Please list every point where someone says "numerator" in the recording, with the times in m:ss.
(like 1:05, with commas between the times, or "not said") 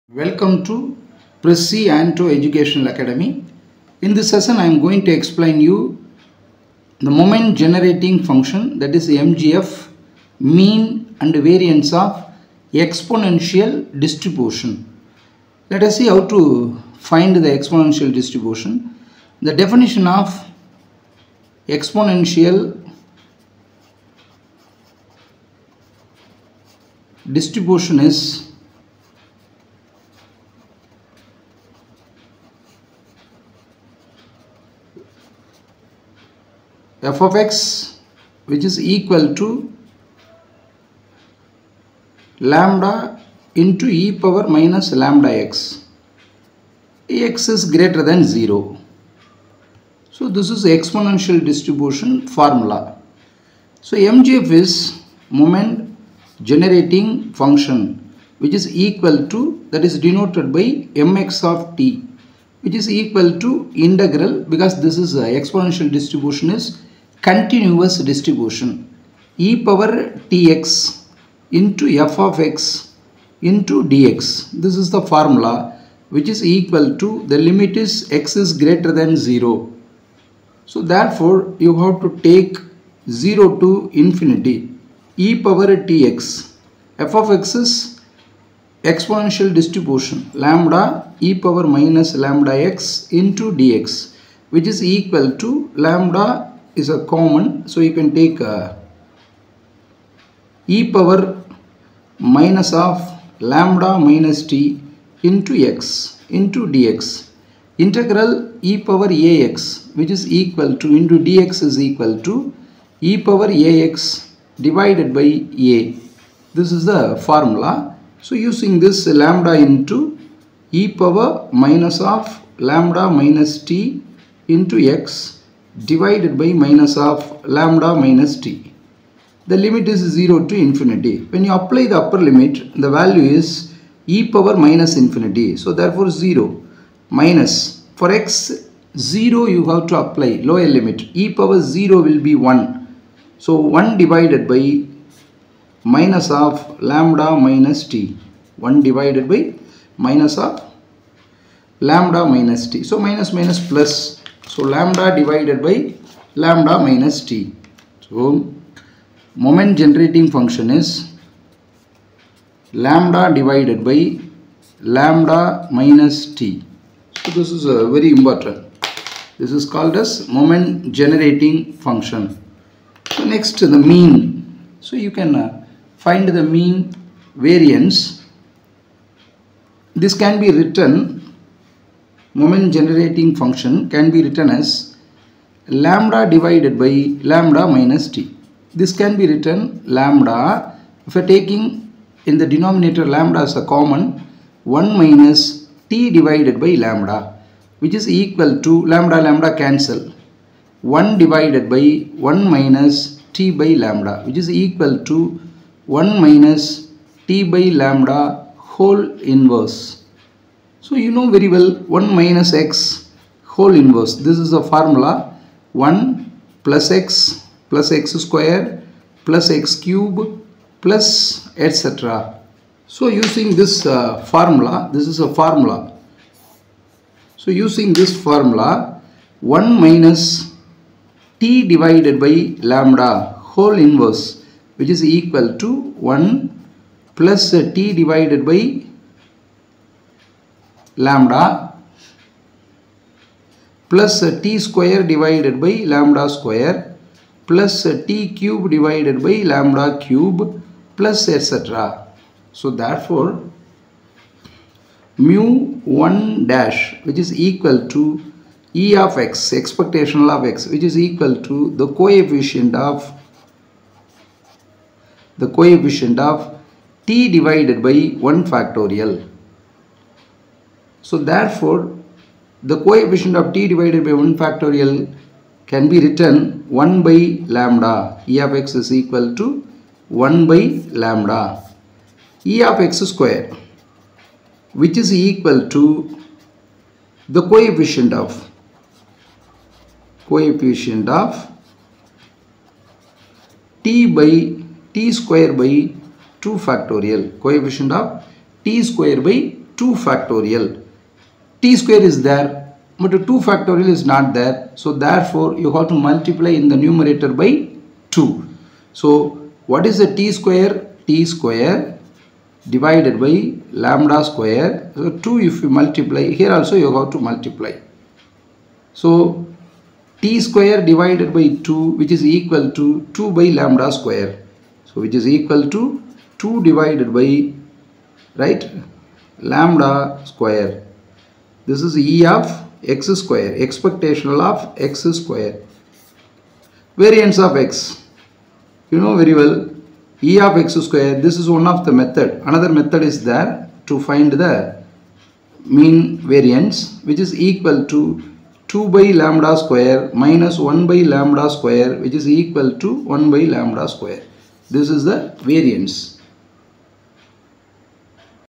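5:06.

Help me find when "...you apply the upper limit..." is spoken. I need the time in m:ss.
2:11.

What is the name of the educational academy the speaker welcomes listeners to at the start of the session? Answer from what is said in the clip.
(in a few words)
Prisci Anto Educational Academy.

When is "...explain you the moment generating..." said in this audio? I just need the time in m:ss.
0:05.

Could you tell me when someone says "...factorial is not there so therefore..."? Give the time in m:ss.
5:03.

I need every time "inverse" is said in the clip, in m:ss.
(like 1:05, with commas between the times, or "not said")
3:29, 3:33, 3:53.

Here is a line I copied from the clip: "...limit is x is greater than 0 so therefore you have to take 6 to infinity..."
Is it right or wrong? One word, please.
wrong.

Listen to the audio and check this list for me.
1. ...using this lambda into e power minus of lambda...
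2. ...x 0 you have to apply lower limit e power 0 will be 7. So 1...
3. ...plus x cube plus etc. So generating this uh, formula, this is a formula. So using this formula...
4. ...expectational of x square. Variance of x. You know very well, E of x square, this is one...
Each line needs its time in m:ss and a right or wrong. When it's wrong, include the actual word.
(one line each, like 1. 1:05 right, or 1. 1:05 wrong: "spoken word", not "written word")
1. 1:58 right
2. 2:18 wrong: "1", not "7"
3. 3:39 wrong: "using", not "generating"
4. 5:33 right.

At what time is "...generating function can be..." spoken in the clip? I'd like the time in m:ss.
3:02.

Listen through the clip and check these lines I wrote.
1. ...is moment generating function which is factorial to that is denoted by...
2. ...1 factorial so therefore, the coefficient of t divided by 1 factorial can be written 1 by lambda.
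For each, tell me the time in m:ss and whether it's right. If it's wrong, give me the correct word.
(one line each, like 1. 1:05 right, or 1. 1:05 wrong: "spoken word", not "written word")
1. 0:54 wrong: "equal", not "factorial"
2. 4:28 right.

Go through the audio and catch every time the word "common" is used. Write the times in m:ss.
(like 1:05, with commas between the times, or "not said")
1:37, 3:13.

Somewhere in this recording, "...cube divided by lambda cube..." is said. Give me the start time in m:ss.
4:08.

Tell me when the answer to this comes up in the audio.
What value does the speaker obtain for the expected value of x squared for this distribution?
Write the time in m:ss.
5:26.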